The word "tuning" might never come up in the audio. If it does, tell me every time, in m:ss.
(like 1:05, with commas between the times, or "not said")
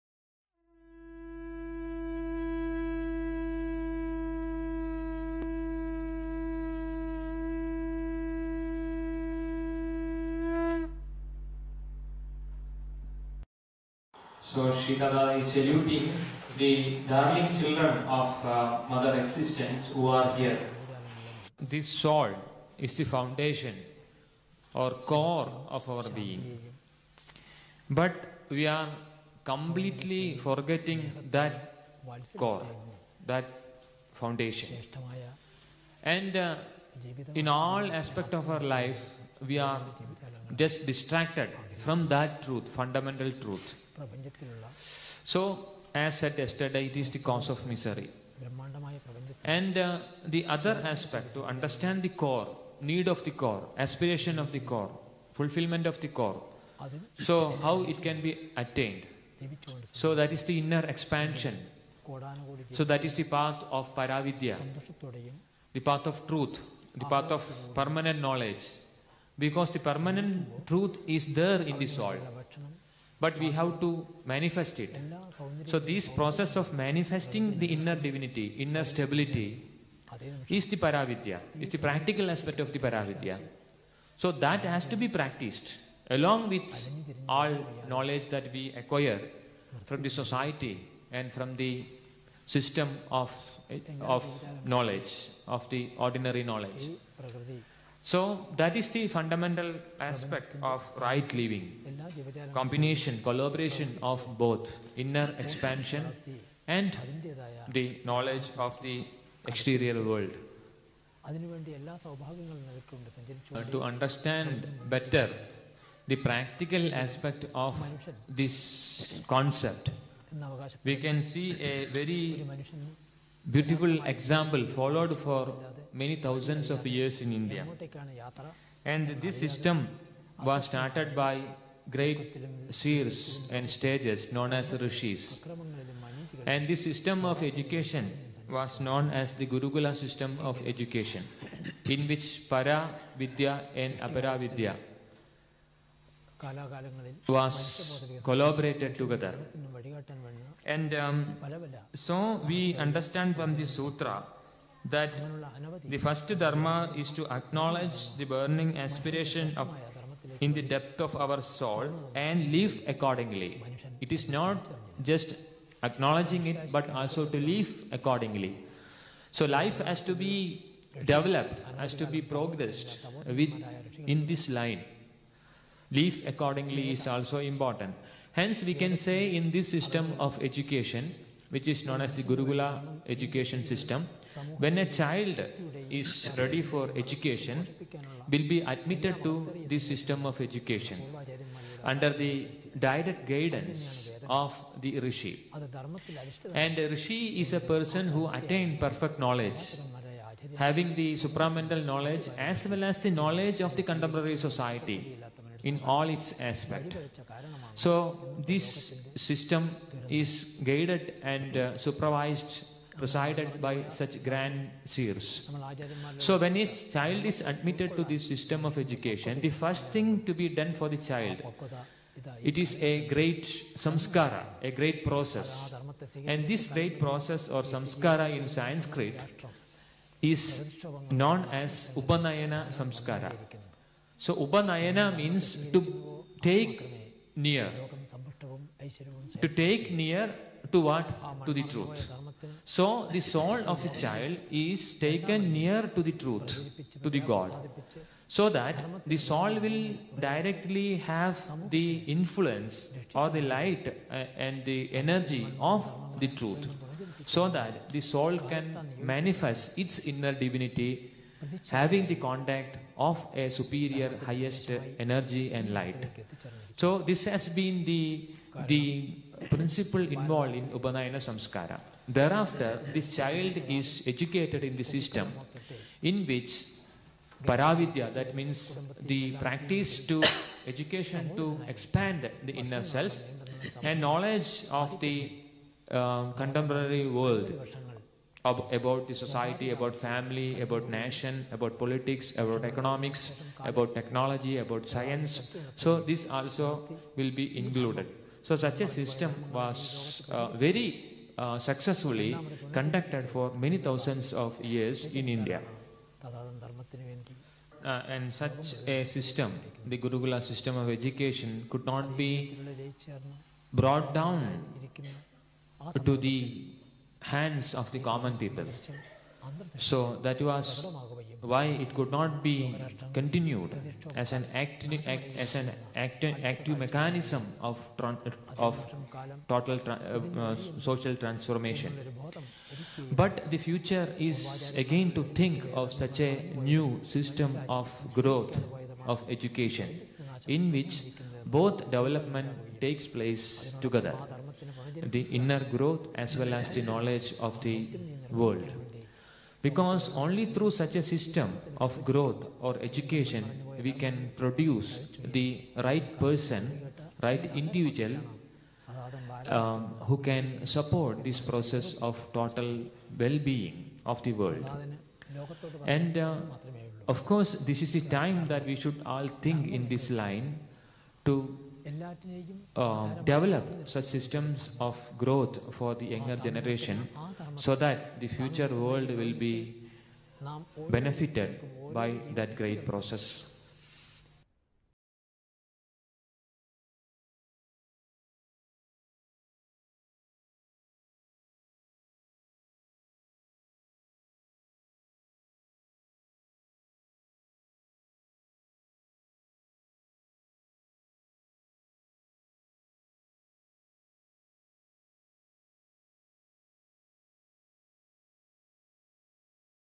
not said.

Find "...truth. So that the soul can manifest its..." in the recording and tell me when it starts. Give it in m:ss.
4:16.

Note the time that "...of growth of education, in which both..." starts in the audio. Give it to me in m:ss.
5:37.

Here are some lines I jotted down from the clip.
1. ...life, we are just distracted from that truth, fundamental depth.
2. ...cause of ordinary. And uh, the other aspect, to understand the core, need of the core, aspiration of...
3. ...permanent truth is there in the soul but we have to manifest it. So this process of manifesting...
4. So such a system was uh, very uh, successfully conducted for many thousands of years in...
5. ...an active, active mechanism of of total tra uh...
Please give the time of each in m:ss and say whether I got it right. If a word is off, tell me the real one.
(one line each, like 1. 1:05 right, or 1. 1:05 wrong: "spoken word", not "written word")
1. 0:38 wrong: "truth", not "depth"
2. 0:47 wrong: "misery", not "ordinary"
3. 1:09 right
4. 4:58 right
5. 5:25 right.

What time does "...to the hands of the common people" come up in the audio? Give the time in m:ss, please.
5:16.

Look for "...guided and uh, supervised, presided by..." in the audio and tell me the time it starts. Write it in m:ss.
3:30.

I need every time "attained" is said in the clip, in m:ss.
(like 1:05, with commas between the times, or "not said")
0:58, 3:18.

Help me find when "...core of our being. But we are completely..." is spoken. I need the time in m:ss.
0:25.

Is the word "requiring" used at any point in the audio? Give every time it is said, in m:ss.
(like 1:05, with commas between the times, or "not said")
not said.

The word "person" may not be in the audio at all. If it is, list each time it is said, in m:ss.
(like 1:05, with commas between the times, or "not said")
3:17, 5:56.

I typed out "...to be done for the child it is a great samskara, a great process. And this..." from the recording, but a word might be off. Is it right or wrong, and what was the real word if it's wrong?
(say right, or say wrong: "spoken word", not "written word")
right.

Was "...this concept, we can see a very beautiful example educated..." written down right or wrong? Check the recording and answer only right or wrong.
wrong.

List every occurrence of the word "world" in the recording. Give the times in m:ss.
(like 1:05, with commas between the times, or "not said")
1:50, 4:47, 5:48, 6:04, 6:18.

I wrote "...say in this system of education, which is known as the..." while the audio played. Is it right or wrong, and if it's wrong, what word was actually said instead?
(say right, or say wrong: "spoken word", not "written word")
right.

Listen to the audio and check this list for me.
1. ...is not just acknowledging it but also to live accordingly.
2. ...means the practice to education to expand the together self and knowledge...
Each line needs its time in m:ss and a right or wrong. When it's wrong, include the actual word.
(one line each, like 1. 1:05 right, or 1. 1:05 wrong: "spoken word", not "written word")
1. 2:44 right
2. 4:38 wrong: "inner", not "together".